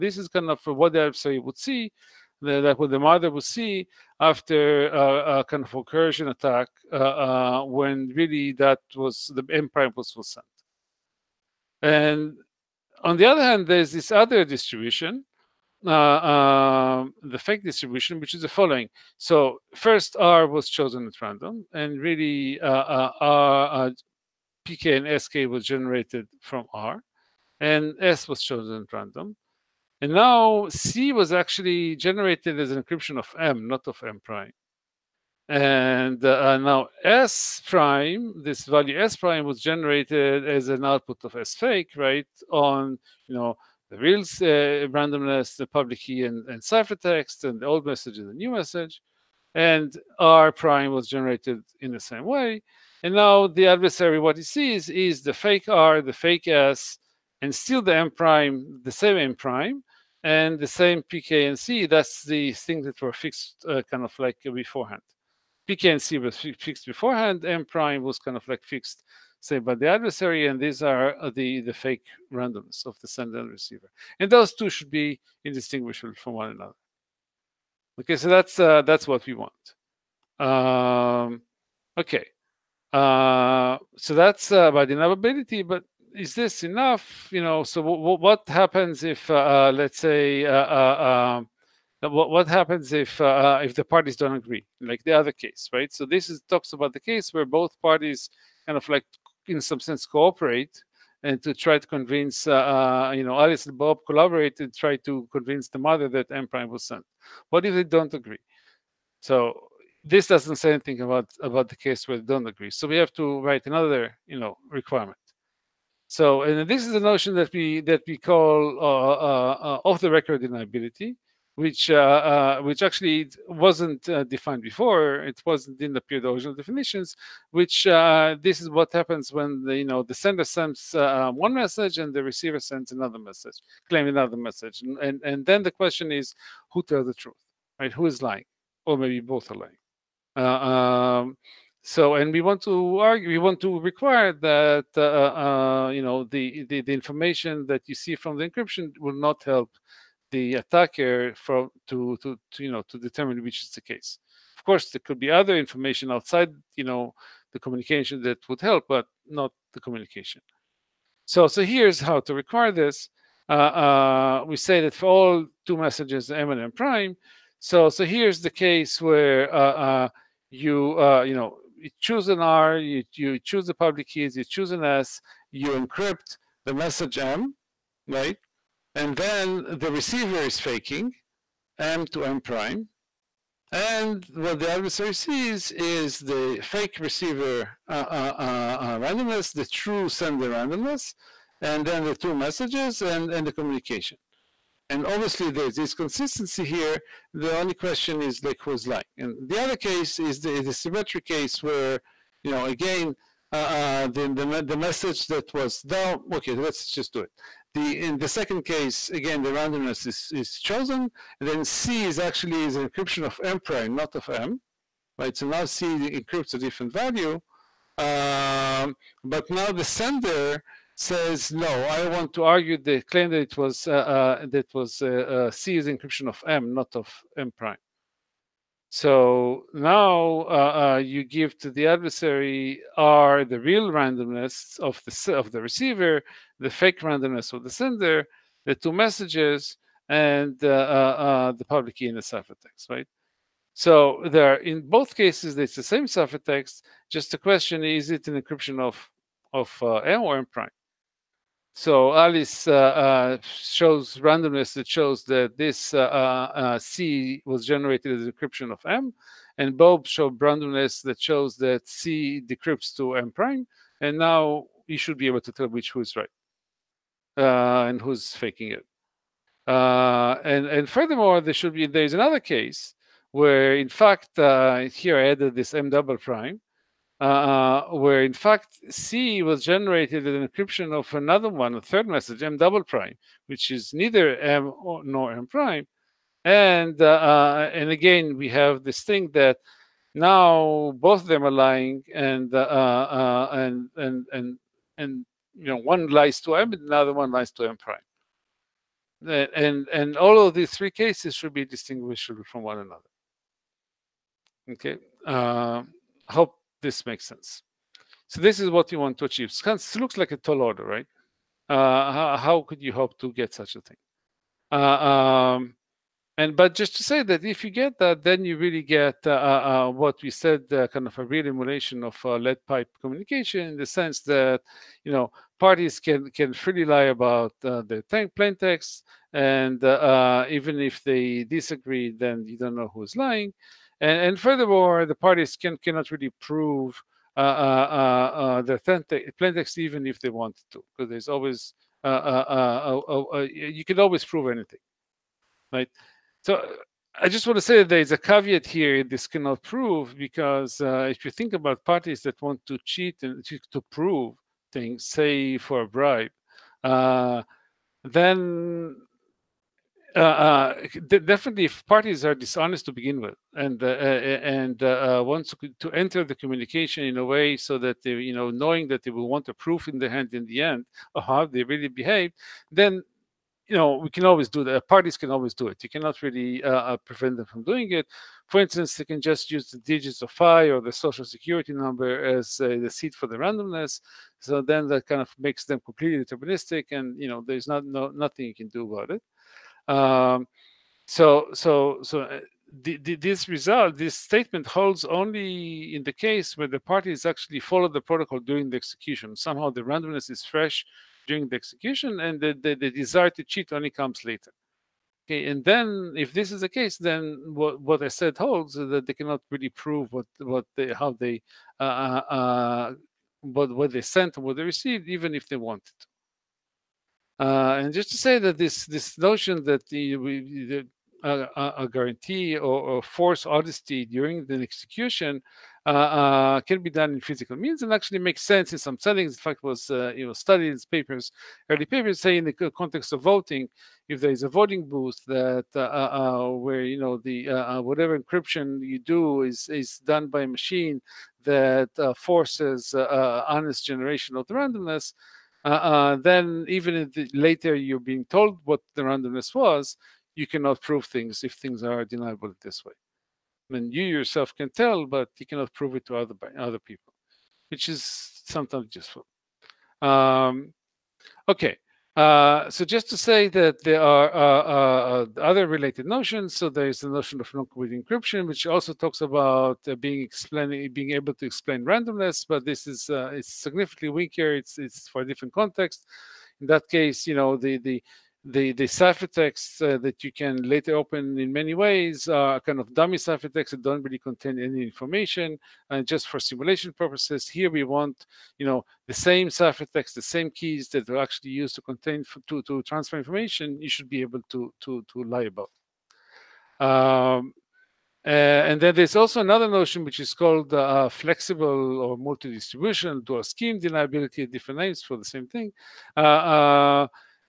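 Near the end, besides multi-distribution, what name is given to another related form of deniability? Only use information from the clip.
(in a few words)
flexible.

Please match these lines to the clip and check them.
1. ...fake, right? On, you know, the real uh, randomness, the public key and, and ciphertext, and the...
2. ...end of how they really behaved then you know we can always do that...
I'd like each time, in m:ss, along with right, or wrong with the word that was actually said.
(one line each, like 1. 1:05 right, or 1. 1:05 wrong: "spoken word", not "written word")
1. 0:41 right
2. 6:10 right.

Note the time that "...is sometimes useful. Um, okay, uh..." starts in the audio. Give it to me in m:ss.
7:37.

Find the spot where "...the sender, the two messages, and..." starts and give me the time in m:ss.
3:57.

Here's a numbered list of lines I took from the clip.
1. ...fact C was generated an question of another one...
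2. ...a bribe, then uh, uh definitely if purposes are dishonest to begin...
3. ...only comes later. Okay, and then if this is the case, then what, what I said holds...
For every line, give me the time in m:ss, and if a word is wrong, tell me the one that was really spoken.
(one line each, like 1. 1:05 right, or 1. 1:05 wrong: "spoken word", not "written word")
1. 4:38 wrong: "encryption", not "question"
2. 5:55 wrong: "parties", not "purposes"
3. 6:43 right.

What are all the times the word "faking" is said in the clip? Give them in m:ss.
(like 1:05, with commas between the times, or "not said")
3:00, 4:28.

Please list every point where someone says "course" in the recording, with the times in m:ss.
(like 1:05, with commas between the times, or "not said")
2:34.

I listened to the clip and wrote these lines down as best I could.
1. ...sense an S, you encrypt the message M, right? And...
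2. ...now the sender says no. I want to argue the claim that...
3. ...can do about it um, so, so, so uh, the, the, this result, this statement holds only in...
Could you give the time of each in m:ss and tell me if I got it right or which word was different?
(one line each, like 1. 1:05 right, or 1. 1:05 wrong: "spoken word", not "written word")
1. 2:54 wrong: "choose", not "sense"
2. 3:39 right
3. 6:28 right.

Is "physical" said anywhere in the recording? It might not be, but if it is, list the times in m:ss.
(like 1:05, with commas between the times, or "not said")
7:07.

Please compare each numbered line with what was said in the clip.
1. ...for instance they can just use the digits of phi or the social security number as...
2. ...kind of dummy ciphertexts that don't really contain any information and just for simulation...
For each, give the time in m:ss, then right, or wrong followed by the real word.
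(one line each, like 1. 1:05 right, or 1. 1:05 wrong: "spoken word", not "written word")
1. 6:18 right
2. 8:02 right.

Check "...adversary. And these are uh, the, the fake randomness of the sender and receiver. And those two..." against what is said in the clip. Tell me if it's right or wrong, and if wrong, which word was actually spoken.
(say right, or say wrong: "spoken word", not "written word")
right.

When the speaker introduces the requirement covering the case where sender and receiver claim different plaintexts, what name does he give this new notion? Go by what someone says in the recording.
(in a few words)
off the record deniability.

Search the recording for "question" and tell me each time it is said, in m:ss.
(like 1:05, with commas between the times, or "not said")
2:15, 3:17, 4:07.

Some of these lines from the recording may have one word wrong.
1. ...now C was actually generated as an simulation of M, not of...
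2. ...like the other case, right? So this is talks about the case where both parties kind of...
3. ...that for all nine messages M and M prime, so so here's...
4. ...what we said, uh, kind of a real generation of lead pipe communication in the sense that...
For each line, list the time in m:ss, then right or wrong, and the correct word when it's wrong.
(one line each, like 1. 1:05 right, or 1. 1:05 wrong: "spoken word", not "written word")
1. 0:30 wrong: "encryption", not "simulation"
2. 1:34 right
3. 2:44 wrong: "two", not "nine"
4. 5:19 wrong: "emulation", not "generation".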